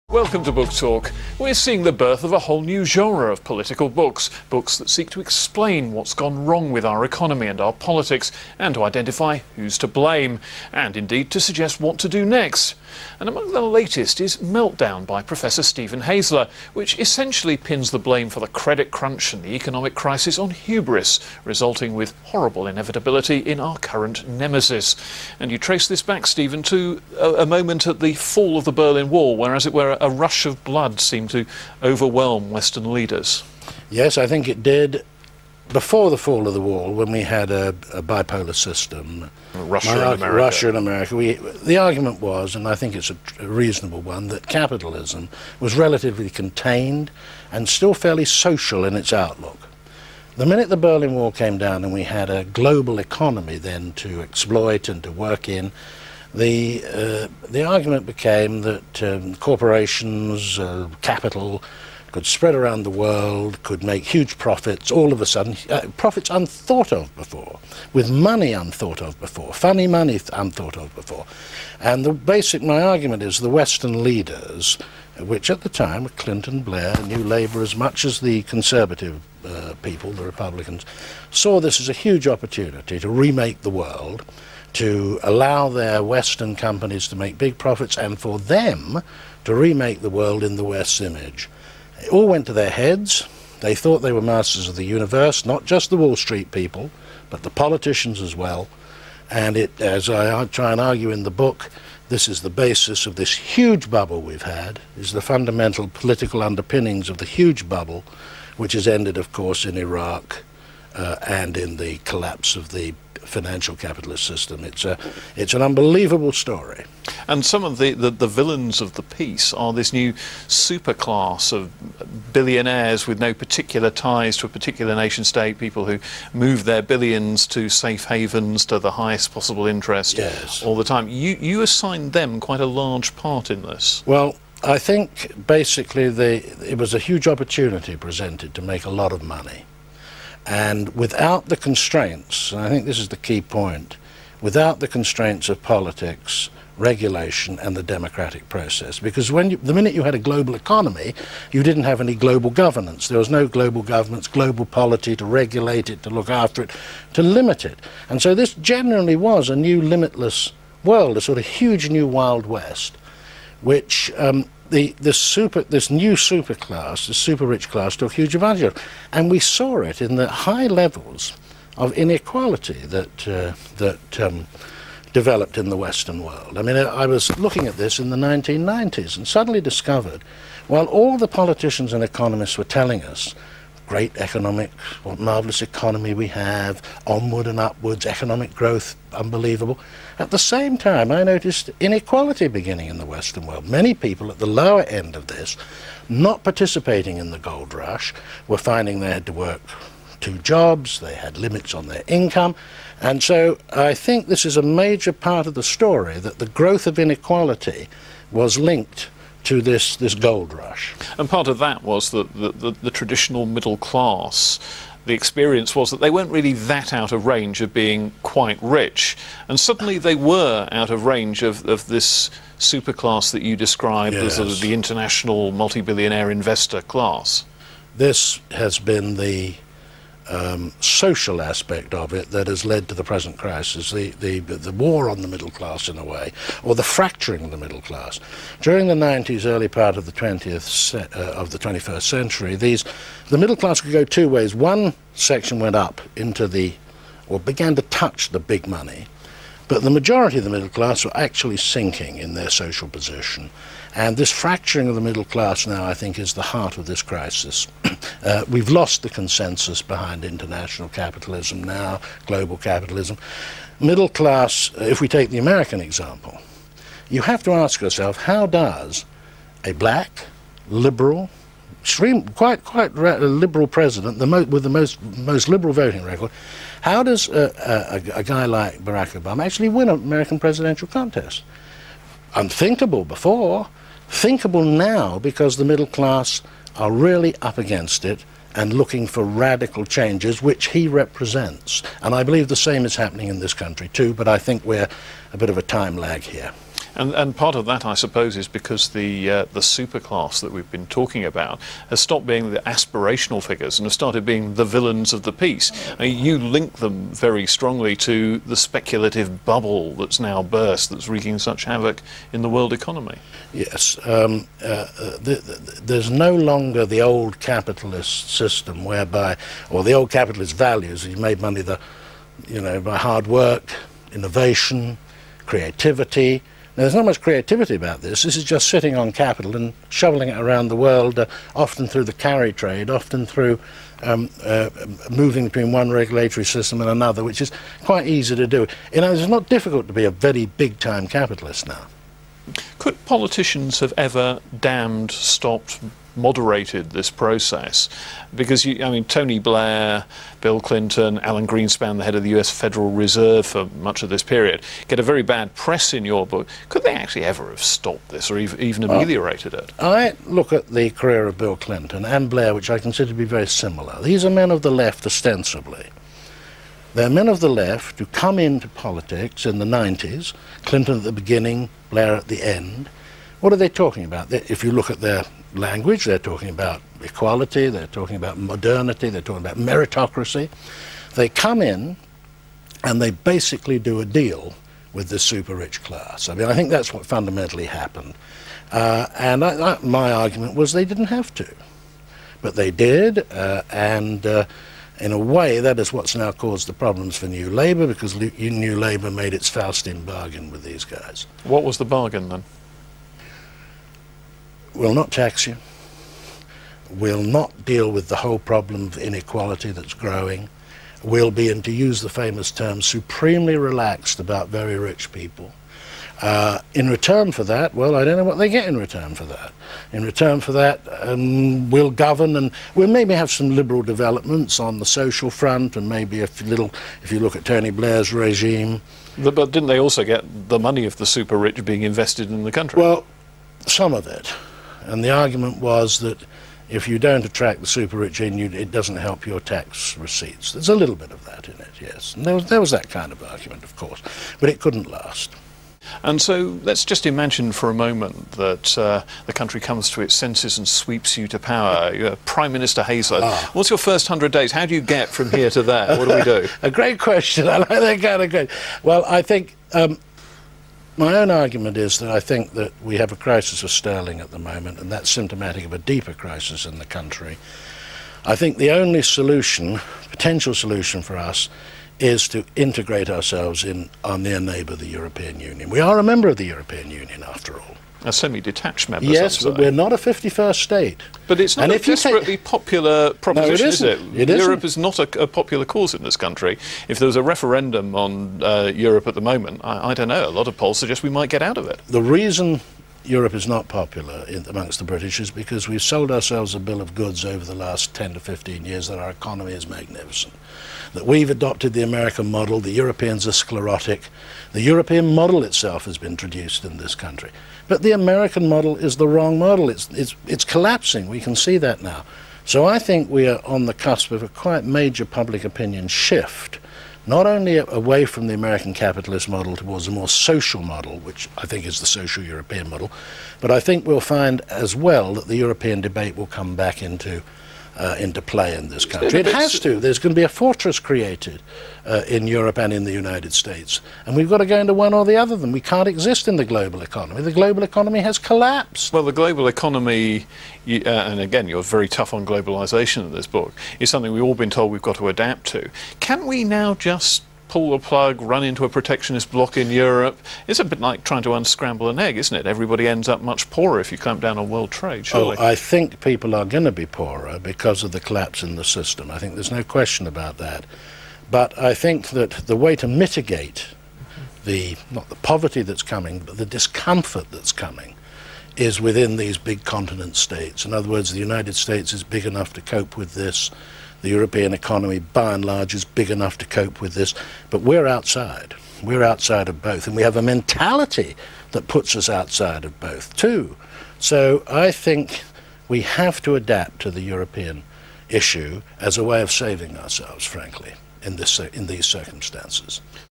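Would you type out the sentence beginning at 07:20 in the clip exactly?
There's a little bit of that in it, yes.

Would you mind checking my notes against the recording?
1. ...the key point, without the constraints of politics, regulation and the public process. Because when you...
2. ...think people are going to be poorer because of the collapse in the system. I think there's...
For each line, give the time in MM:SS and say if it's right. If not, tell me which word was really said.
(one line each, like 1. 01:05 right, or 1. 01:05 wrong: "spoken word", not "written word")
1. 02:23 wrong: "democratic", not "public"
2. 09:15 right.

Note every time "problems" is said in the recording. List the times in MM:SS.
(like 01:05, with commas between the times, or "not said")
06:36, 06:48.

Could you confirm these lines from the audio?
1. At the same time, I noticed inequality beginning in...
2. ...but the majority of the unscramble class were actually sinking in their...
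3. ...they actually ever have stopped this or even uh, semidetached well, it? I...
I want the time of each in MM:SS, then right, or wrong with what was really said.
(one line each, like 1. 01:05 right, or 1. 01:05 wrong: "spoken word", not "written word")
1. 03:10 right
2. 04:09 wrong: "middle", not "unscramble"
3. 05:56 wrong: "ameliorated", not "semidetached".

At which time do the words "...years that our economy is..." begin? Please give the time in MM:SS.
08:18.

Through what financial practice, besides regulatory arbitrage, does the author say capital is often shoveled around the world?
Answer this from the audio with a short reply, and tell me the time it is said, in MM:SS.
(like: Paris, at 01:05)
the carry trade, at 05:32.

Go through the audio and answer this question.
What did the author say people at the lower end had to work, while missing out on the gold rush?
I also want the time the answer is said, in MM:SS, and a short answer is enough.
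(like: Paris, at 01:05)
two jobs, at 03:20.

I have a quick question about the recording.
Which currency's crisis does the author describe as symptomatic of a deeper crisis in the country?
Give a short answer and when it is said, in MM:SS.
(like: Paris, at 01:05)
sterling, at 07:43.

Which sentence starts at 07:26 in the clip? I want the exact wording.
And so let's just imagine for a moment that uh, the country comes to its senses and sweeps you to power.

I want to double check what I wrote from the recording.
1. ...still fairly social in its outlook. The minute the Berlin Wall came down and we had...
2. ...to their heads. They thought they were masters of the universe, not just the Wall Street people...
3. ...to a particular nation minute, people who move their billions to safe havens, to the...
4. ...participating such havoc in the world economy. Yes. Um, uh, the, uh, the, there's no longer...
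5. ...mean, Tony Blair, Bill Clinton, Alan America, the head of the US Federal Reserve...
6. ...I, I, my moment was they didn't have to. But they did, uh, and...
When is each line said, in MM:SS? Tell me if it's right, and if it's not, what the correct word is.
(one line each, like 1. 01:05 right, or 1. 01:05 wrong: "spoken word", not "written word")
1. 00:47 right
2. 01:32 right
3. 02:04 wrong: "state", not "minute"
4. 05:11 wrong: "wreaking", not "participating"
5. 05:48 wrong: "Greenspan", not "America"
6. 06:29 wrong: "argument", not "moment".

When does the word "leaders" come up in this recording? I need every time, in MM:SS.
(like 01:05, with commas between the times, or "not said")
00:32, 01:14.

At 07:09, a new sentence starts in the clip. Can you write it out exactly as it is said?
But, but didn't they also get the money of the super rich being invested in the country?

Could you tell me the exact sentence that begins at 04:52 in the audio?
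And I believe the same is happening in this country too, but I think we're a bit of a time lag here.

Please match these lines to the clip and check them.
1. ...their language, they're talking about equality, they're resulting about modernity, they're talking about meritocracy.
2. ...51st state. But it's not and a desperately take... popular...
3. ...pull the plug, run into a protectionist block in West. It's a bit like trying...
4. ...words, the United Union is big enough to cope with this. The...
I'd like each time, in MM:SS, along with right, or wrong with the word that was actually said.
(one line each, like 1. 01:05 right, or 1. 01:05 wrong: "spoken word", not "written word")
1. 06:14 wrong: "talking", not "resulting"
2. 07:59 right
3. 09:07 wrong: "Europe", not "West"
4. 09:30 wrong: "States", not "Union".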